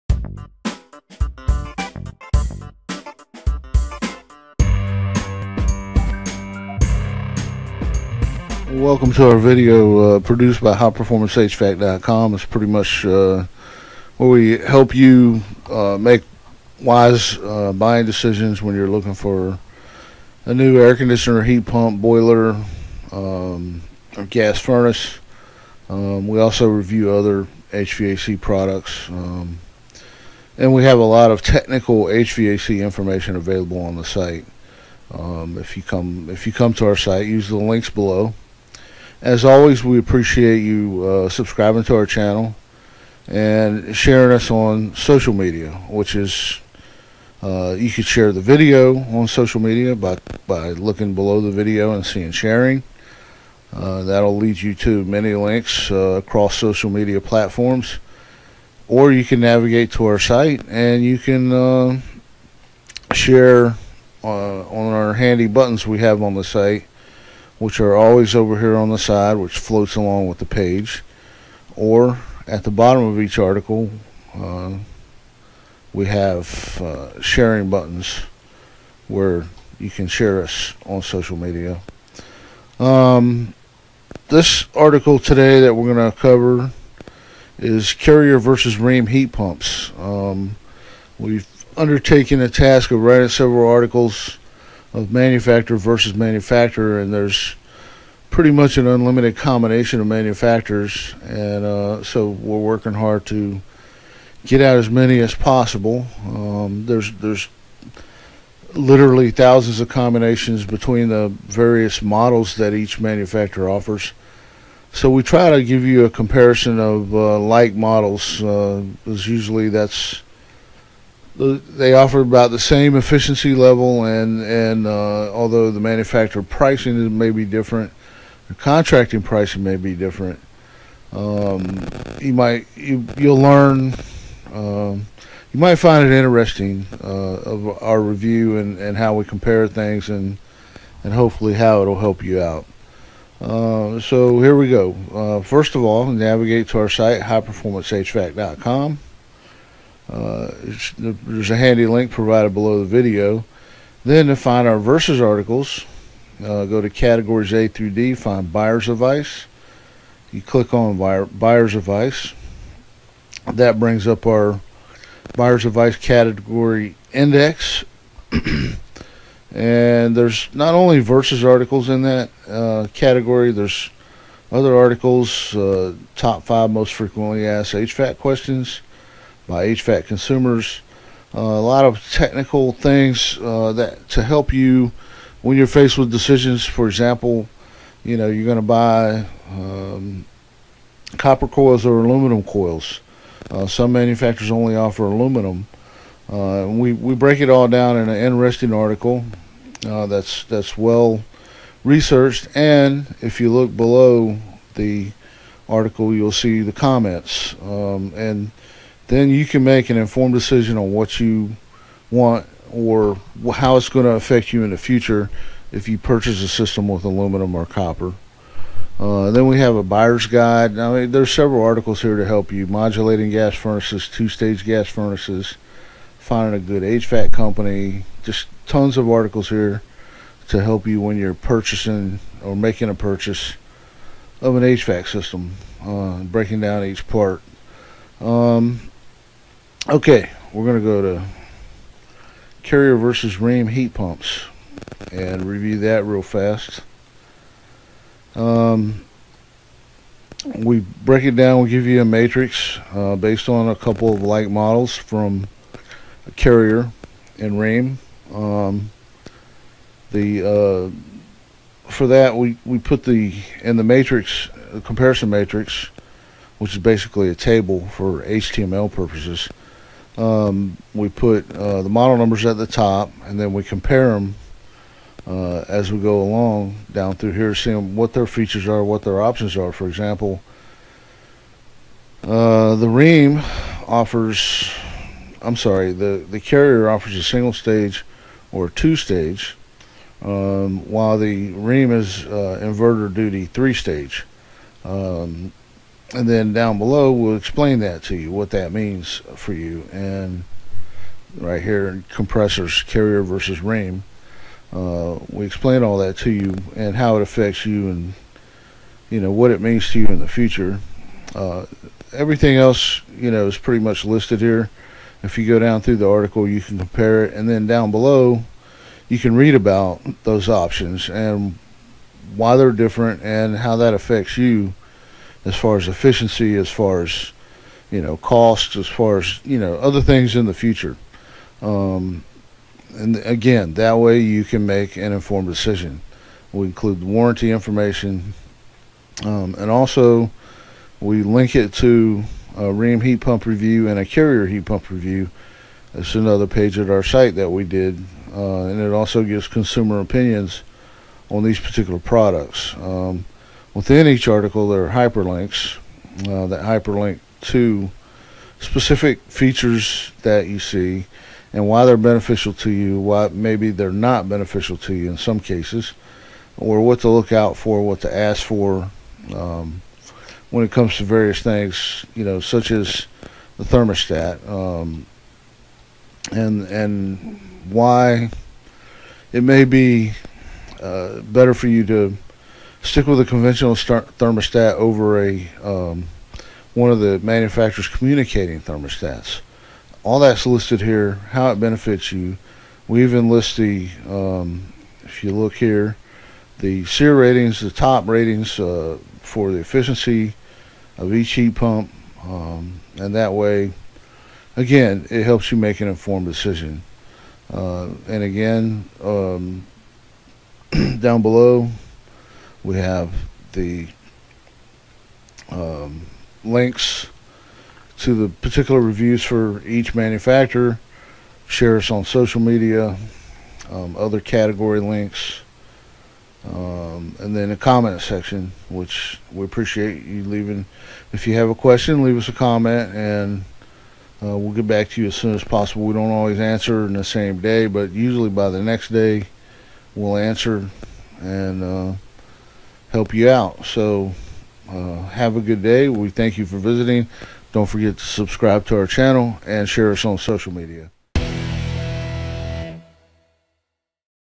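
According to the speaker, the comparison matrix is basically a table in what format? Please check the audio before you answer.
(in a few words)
HTML.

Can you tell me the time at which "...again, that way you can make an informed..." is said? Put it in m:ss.
5:33.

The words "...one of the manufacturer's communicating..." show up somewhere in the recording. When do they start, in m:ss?
6:26.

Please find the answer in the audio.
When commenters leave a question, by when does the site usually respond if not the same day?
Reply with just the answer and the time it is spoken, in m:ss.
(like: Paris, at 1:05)
the next day, at 7:18.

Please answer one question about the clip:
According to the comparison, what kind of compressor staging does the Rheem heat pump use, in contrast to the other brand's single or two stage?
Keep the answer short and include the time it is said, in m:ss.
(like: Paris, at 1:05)
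inverter duty three stage, at 4:52.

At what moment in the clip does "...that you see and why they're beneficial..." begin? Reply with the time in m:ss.
6:00.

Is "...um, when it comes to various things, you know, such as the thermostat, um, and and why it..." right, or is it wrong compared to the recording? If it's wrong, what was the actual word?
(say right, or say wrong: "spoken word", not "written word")
right.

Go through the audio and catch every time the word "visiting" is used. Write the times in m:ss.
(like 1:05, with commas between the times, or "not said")
7:26.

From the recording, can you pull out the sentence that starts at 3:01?
Uh, a lot of technical things uh, that to help you when you're faced with decisions.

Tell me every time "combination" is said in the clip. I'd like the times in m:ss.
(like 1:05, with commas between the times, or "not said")
1:39, 1:49.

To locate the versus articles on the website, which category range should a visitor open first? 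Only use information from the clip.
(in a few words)
A through D.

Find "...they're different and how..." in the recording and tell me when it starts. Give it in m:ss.
5:22.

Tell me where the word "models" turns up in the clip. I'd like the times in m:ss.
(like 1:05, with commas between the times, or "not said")
1:52, 1:57, 4:14, 4:31.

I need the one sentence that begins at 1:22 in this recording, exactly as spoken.
Um, this article today that we're going to cover is Carrier versus Rheem heat pumps.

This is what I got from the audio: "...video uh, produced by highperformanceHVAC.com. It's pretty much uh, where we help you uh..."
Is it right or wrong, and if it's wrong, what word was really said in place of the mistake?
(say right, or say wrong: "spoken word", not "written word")
right.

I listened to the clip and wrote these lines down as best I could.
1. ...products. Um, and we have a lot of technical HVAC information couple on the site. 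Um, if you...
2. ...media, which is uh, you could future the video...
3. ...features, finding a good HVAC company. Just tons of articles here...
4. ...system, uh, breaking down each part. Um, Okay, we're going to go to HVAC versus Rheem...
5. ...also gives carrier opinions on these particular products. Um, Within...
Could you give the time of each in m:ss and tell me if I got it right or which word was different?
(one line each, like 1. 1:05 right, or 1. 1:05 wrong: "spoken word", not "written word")
1. 0:28 wrong: "available", not "couple"
2. 0:45 wrong: "share", not "future"
3. 3:44 wrong: "furnaces", not "features"
4. 3:55 wrong: "Carrier", not "HVAC"
5. 5:48 wrong: "consumer", not "carrier".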